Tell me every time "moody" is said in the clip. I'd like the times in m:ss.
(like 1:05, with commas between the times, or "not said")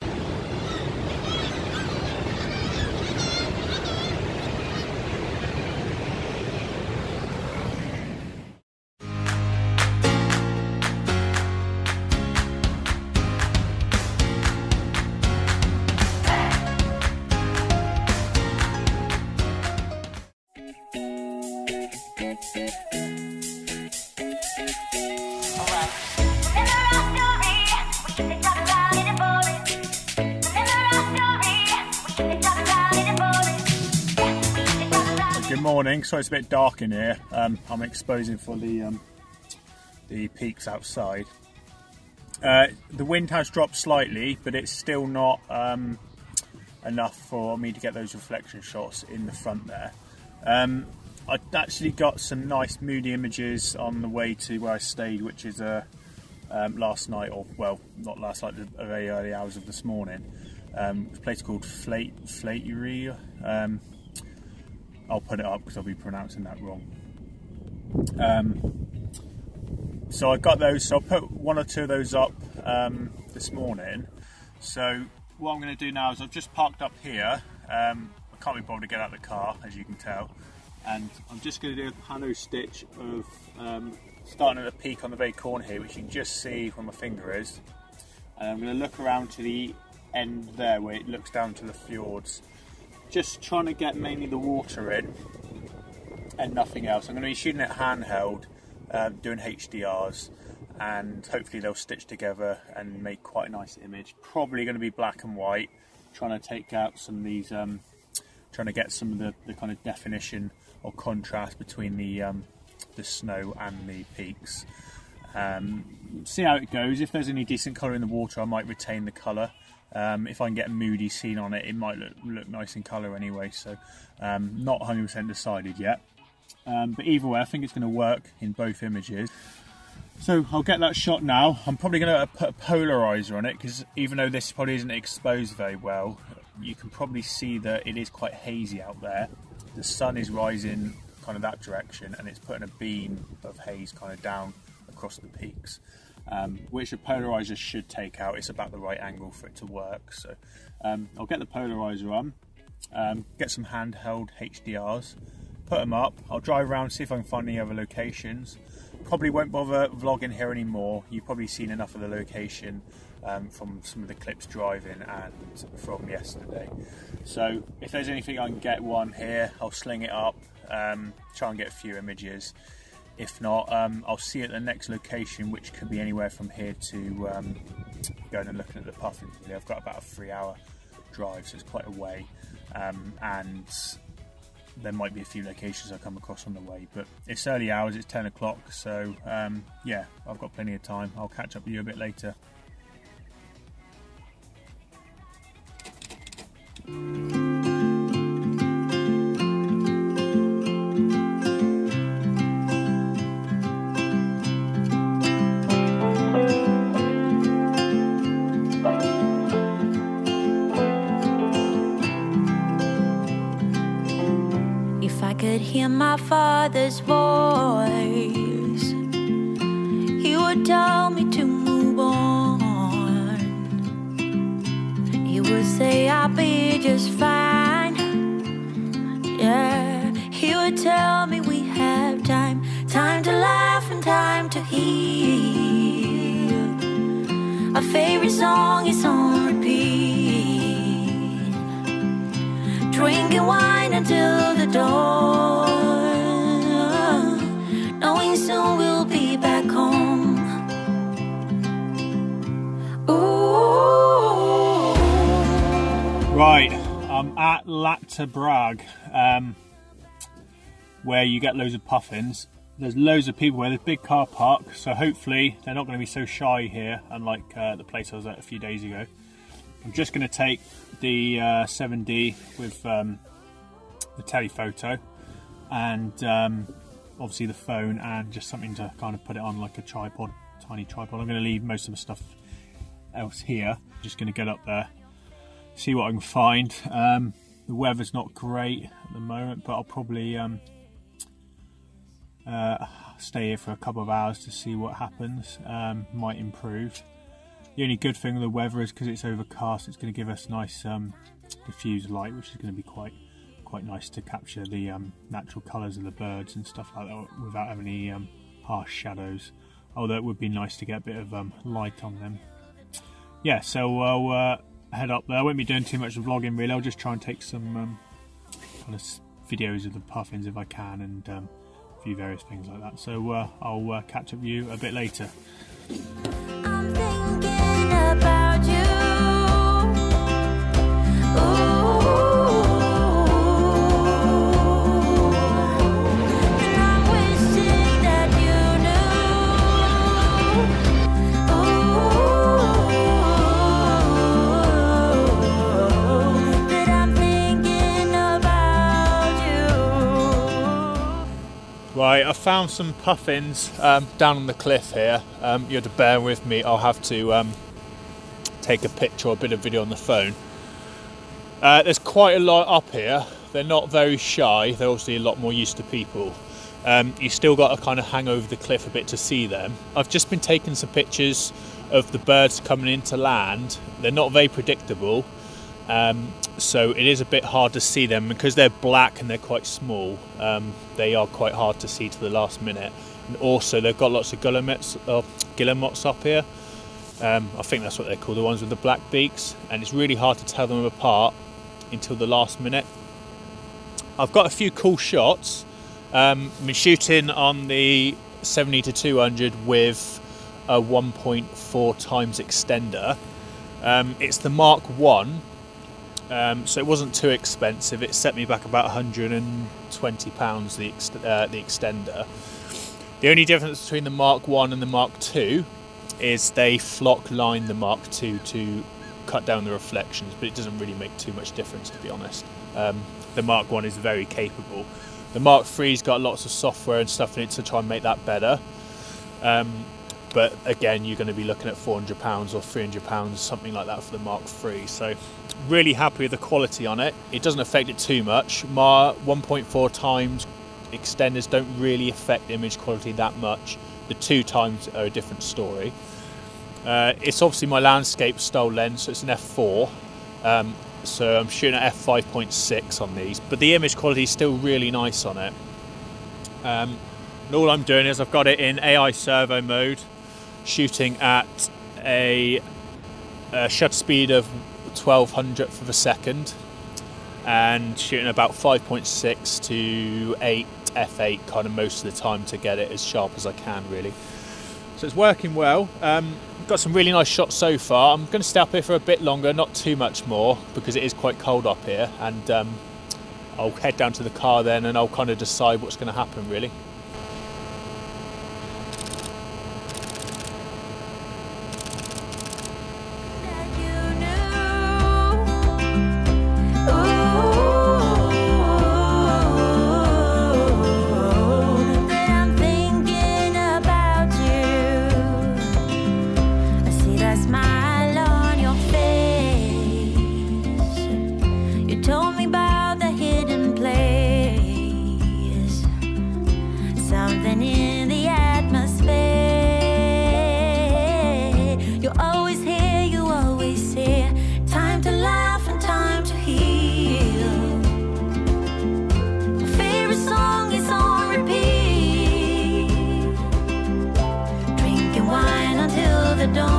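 0:52, 2:00.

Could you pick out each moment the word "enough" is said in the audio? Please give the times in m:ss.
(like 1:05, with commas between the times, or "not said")
0:46, 2:41.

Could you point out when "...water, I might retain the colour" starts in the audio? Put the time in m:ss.
1:58.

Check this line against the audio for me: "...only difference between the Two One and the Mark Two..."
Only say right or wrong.
wrong.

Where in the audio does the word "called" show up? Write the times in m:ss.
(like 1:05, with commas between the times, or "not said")
1:01, 6:28.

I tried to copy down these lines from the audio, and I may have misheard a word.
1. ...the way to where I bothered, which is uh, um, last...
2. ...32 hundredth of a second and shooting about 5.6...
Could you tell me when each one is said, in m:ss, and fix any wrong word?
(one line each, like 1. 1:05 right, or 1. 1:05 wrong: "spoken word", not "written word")
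1. 0:54 wrong: "stayed", not "bothered"
2. 7:44 wrong: "12", not "32".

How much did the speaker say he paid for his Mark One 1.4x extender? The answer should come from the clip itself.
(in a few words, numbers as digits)
120 pounds.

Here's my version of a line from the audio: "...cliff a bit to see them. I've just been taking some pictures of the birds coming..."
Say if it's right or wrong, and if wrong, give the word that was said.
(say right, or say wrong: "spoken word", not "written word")
right.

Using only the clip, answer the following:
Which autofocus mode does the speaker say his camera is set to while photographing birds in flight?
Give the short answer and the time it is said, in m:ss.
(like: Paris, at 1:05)
AI servo, at 7:38.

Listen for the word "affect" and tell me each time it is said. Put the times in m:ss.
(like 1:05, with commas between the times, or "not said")
7:17, 7:22.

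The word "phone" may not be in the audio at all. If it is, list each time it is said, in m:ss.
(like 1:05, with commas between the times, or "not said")
4:37, 5:59.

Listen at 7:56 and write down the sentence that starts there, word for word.
Um, got some really nice shots so far.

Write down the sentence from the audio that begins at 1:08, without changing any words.
Um, so I got those, so I put one or two of those up um, this morning.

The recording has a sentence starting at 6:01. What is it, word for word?
Uh, there's quite a lot up here.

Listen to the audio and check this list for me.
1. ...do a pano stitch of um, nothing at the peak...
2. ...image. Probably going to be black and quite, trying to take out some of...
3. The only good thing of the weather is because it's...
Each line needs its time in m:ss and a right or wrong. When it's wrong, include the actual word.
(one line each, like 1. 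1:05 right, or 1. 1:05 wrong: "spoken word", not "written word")
1. 1:21 wrong: "starting", not "nothing"
2. 1:43 wrong: "white", not "quite"
3. 4:57 right.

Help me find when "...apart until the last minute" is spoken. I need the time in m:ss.
6:30.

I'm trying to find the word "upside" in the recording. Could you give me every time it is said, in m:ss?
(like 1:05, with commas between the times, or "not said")
not said.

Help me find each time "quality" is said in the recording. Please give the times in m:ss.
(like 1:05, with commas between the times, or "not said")
7:16, 7:22, 7:33.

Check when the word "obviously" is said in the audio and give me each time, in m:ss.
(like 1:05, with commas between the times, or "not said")
4:37, 6:04, 7:27.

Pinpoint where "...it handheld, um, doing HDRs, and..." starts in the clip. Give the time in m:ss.
1:37.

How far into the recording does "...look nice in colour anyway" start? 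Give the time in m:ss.
2:02.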